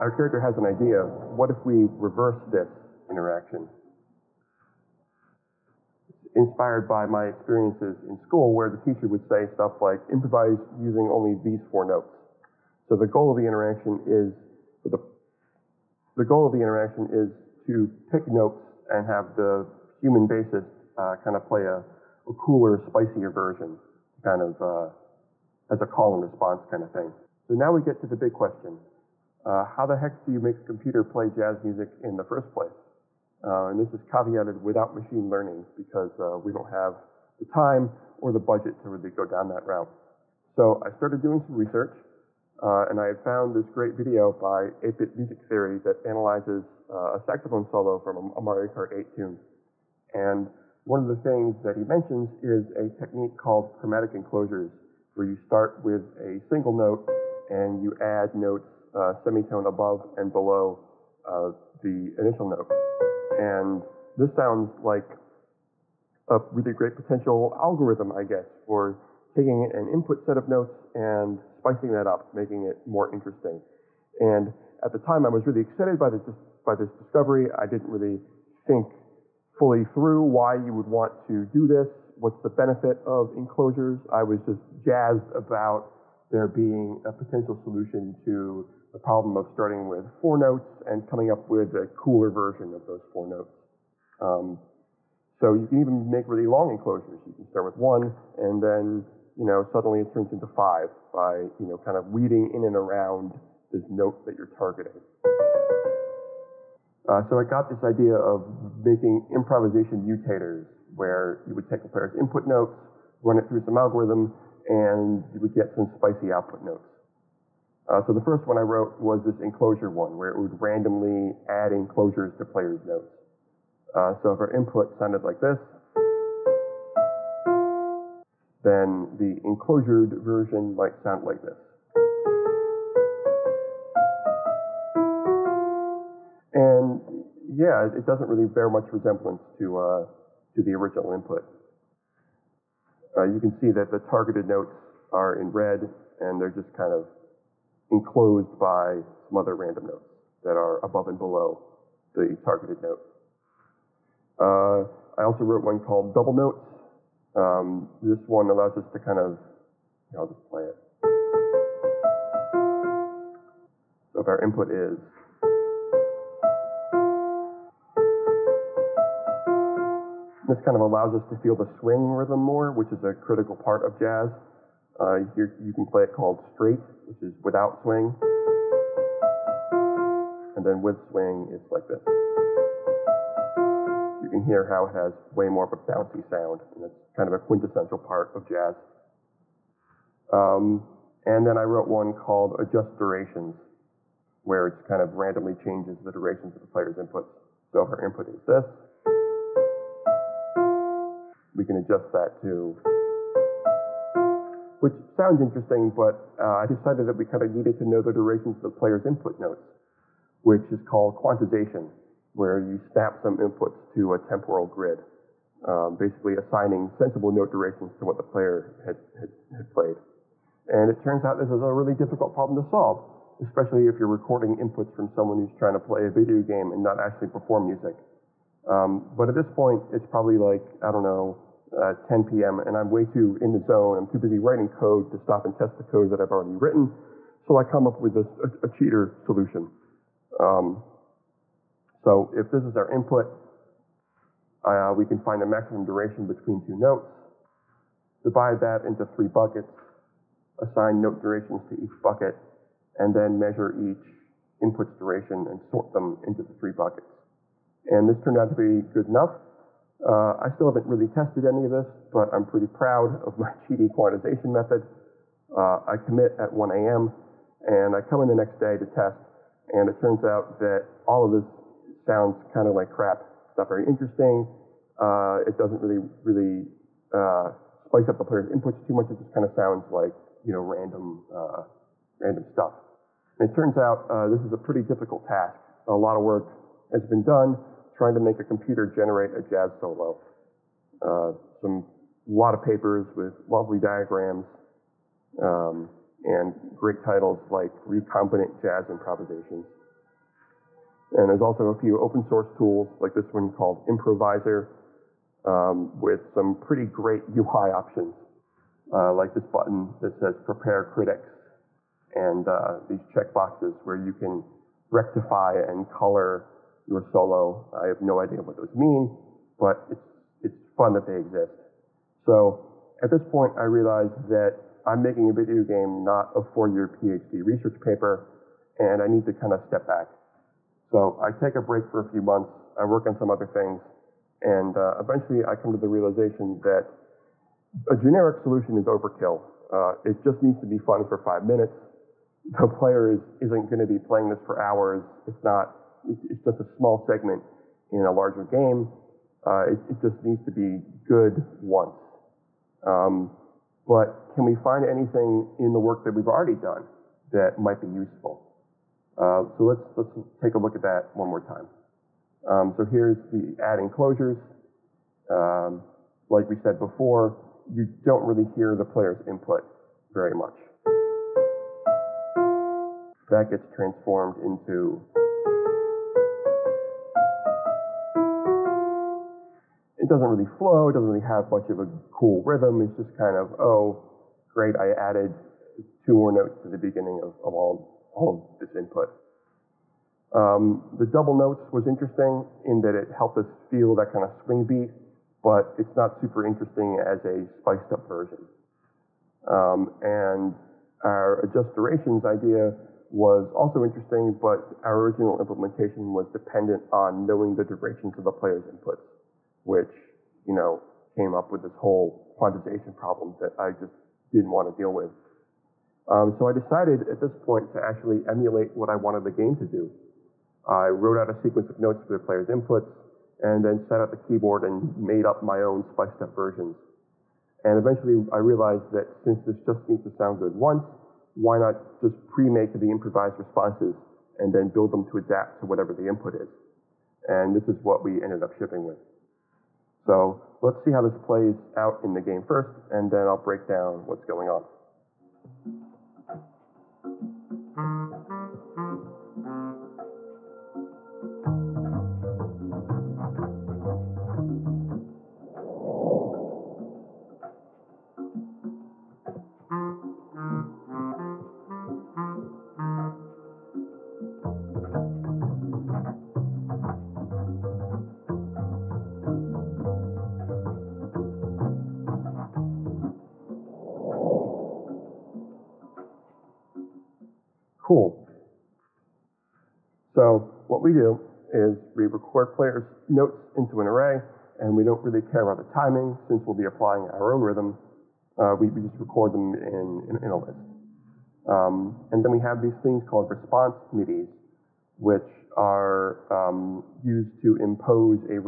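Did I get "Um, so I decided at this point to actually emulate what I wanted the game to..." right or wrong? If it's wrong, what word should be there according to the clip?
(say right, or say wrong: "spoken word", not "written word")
right.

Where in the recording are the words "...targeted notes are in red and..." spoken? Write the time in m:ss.
2:23.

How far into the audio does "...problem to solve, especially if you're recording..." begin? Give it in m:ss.
3:42.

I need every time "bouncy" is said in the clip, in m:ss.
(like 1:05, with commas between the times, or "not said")
3:05.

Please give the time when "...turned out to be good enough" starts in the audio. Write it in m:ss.
4:18.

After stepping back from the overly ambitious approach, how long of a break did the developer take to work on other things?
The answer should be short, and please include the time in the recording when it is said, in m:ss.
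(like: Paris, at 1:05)
A few months, at 5:31.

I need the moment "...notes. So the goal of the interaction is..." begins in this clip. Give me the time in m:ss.
0:11.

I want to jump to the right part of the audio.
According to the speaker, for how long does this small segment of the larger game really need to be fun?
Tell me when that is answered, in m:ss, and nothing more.
5:41.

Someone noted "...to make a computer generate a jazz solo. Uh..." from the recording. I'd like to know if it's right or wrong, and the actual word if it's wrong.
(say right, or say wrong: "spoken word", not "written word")
right.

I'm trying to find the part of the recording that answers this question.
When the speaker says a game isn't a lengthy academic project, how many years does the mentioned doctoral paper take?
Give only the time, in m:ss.
5:26.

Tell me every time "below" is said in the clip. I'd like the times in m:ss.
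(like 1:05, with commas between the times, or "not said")
1:00, 2:31.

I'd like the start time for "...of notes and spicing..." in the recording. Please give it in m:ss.
1:10.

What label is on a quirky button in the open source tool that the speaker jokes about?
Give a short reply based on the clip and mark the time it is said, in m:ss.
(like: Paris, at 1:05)
Prepare Critics, at 5:10.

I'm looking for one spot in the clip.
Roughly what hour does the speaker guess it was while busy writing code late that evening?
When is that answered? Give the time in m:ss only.
3:51.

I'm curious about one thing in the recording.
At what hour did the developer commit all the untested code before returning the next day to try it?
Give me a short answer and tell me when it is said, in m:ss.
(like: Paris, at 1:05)
1 a.m., at 4:26.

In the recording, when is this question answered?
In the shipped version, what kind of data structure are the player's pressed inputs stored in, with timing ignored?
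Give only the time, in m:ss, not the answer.
8:03.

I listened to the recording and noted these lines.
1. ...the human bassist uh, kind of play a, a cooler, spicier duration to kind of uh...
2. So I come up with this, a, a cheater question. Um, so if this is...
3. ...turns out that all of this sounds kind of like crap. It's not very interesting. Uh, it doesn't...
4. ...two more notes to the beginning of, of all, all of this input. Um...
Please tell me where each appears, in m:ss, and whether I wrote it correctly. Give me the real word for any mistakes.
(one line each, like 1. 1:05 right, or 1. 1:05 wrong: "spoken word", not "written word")
1. 0:19 wrong: "version", not "duration"
2. 3:57 wrong: "solution", not "question"
3. 4:29 right
4. 6:25 right.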